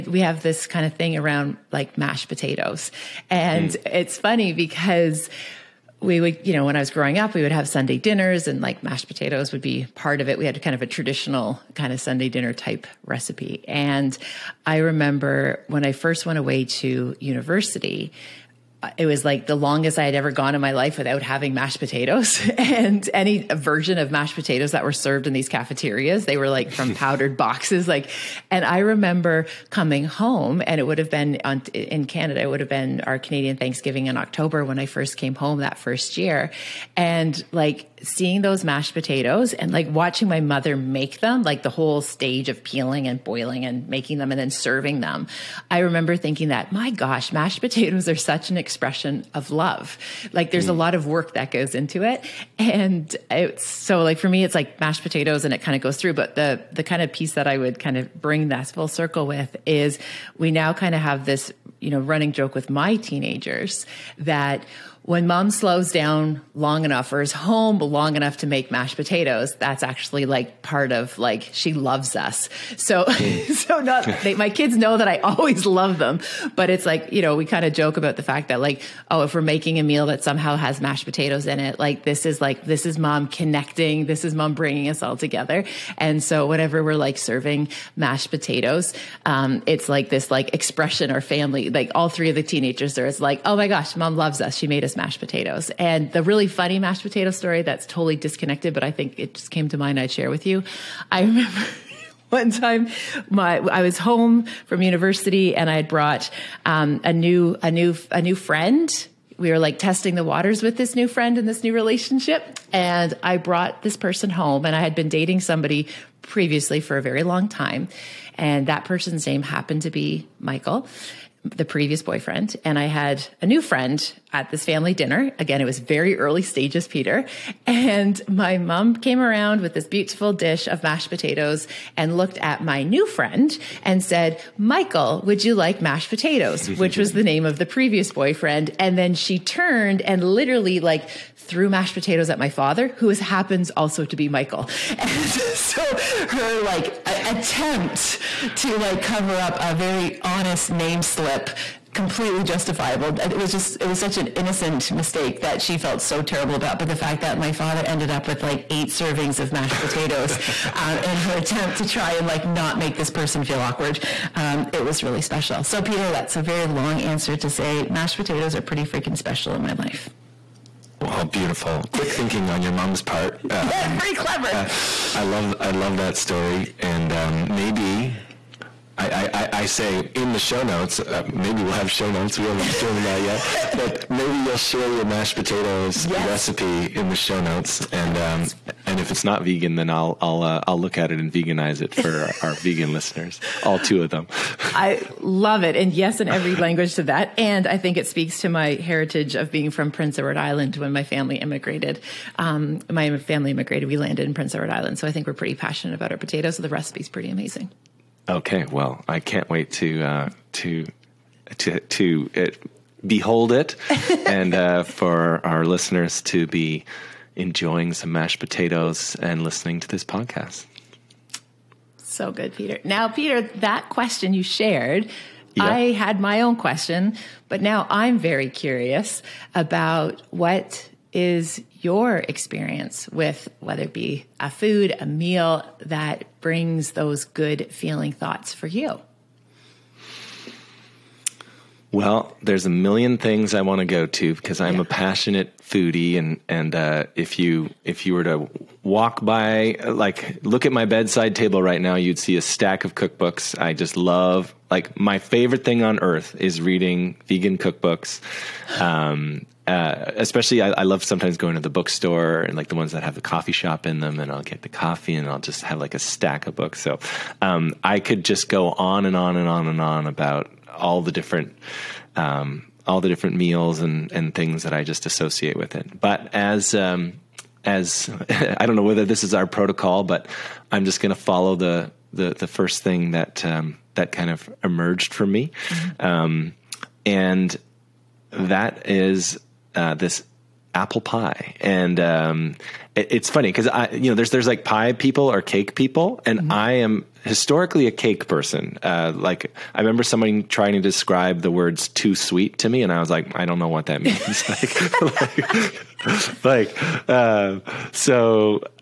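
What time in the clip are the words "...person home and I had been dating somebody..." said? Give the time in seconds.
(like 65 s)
113 s.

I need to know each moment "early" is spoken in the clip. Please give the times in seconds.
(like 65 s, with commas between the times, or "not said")
126 s.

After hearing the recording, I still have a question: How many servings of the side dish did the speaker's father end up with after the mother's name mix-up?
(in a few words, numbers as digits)
8.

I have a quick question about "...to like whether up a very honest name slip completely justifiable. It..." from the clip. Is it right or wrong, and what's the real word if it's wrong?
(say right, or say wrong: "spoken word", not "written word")
wrong: "cover", not "whether".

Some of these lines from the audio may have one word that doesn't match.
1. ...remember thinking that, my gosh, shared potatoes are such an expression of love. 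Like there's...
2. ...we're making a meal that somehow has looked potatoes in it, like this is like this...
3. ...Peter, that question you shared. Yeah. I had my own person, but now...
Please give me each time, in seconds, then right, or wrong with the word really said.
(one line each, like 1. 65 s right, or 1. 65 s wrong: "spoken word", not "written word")
1. 45 s wrong: "mashed", not "shared"
2. 79 s wrong: "mashed", not "looked"
3. 223 s wrong: "question", not "person".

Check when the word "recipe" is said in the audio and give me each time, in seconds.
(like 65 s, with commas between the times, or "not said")
13 s, 186 s, 206 s.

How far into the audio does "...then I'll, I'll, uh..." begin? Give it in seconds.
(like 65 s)
189 s.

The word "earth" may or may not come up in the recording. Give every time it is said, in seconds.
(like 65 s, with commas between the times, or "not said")
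255 s.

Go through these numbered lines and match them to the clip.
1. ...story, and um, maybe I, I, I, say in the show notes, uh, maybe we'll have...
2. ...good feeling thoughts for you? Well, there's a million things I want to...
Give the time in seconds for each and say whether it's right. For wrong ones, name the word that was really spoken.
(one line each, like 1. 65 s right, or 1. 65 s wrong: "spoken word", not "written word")
1. 176 s right
2. 237 s right.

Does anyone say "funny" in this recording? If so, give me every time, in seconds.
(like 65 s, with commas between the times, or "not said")
4 s, 96 s, 293 s.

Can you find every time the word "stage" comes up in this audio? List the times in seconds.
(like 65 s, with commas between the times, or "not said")
41 s, 126 s.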